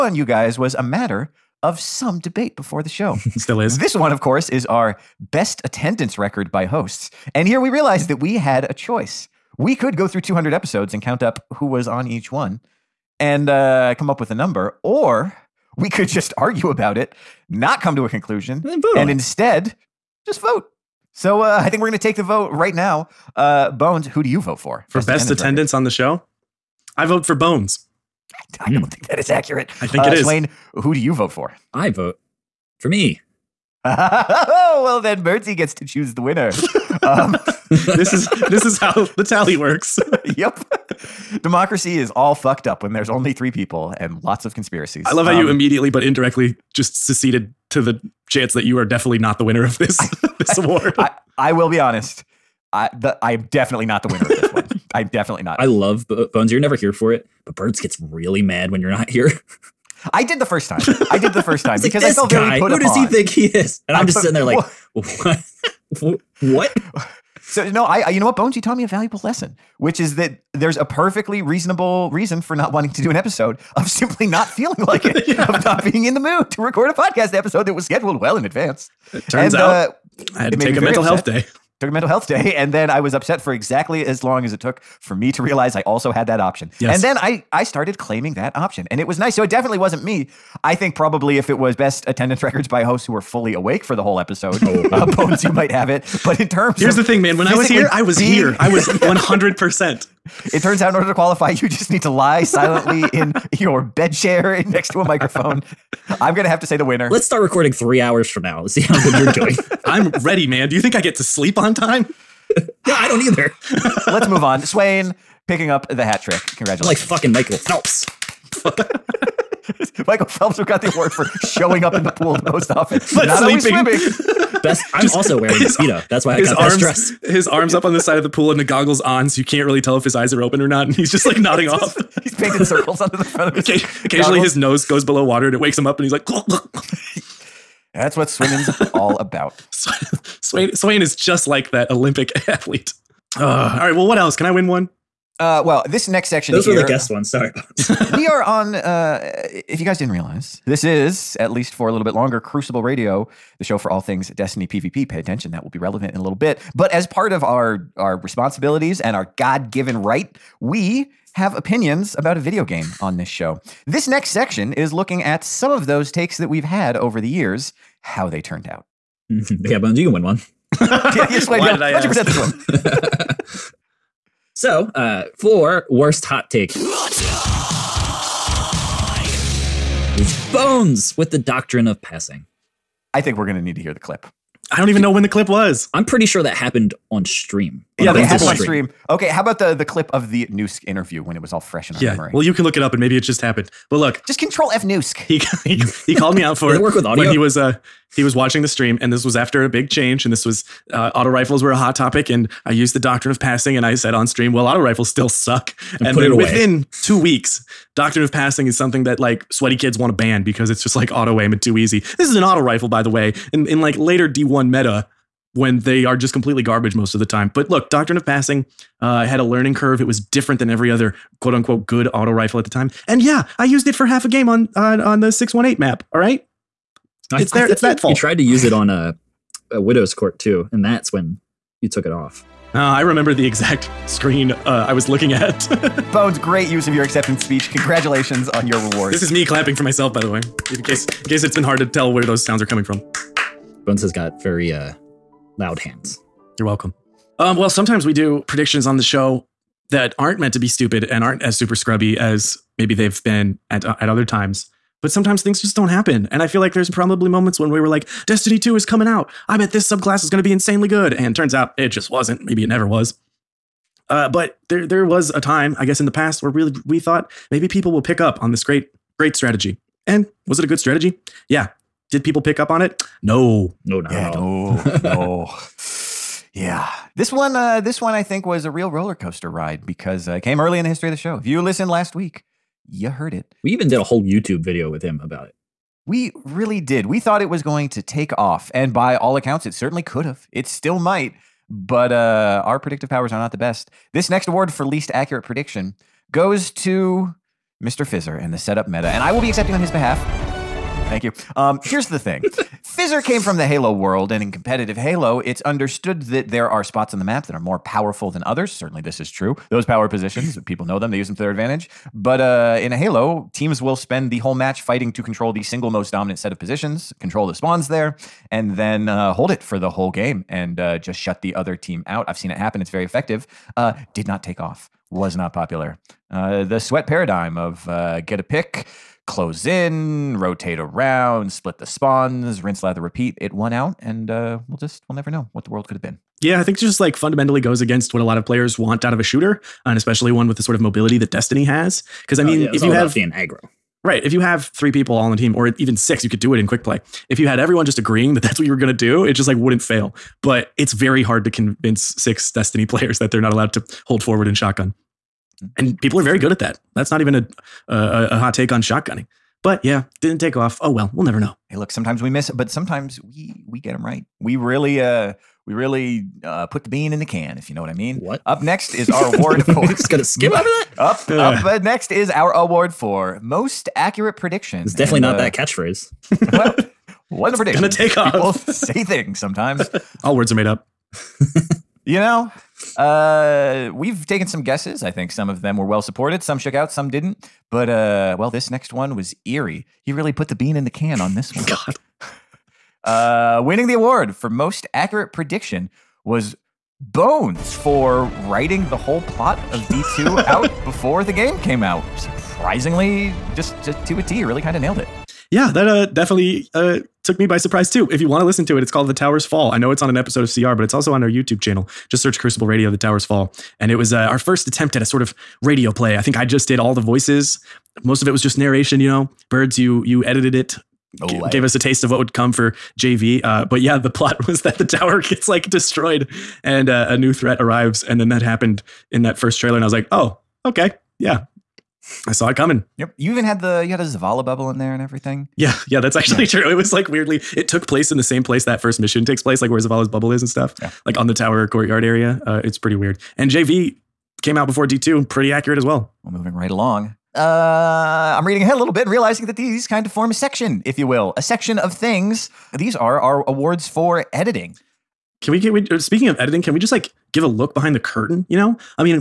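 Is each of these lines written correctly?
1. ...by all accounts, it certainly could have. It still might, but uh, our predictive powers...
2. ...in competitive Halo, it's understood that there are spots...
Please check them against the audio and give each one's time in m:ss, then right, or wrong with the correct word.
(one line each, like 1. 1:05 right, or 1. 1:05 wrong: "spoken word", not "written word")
1. 4:48 right
2. 5:04 right.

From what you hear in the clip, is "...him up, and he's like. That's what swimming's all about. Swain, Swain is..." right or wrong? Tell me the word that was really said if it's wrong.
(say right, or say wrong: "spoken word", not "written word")
right.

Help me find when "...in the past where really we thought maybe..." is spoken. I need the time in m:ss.
4:25.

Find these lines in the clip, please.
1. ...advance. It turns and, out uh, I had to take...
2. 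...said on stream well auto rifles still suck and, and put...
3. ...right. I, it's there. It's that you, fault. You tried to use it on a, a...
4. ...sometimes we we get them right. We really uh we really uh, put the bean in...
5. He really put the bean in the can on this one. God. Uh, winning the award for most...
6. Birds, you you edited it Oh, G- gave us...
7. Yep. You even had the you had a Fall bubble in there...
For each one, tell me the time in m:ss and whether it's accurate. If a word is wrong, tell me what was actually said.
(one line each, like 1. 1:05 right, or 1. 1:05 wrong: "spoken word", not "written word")
1. 1:18 right
2. 3:23 right
3. 3:46 right
4. 6:02 right
5. 6:30 right
6. 6:59 right
7. 7:12 wrong: "Zavala", not "Fall".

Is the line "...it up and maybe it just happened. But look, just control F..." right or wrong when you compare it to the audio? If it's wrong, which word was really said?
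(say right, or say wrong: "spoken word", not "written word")
right.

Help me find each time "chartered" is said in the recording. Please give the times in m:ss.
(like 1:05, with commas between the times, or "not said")
not said.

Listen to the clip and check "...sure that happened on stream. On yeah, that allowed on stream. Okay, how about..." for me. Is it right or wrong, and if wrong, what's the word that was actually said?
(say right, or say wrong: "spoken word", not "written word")
wrong: "happened", not "allowed".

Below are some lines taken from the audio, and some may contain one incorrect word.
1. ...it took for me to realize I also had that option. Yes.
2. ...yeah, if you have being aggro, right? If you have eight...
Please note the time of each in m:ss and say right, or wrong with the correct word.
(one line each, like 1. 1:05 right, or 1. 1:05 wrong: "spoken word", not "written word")
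1. 1:24 right
2. 5:42 wrong: "three", not "eight".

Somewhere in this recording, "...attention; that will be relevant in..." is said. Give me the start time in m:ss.
2:35.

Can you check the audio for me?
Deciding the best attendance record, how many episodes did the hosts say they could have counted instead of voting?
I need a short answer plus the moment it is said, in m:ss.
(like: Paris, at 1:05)
200, at 0:10.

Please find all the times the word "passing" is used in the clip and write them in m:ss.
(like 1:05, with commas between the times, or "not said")
3:02, 3:23, 3:28, 3:38.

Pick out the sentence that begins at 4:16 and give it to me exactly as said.
And I feel like there's probably moments when we were like, Destiny 2 is coming out.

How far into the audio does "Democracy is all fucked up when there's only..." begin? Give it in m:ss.
0:41.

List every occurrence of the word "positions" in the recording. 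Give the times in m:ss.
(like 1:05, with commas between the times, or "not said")
5:10, 5:16.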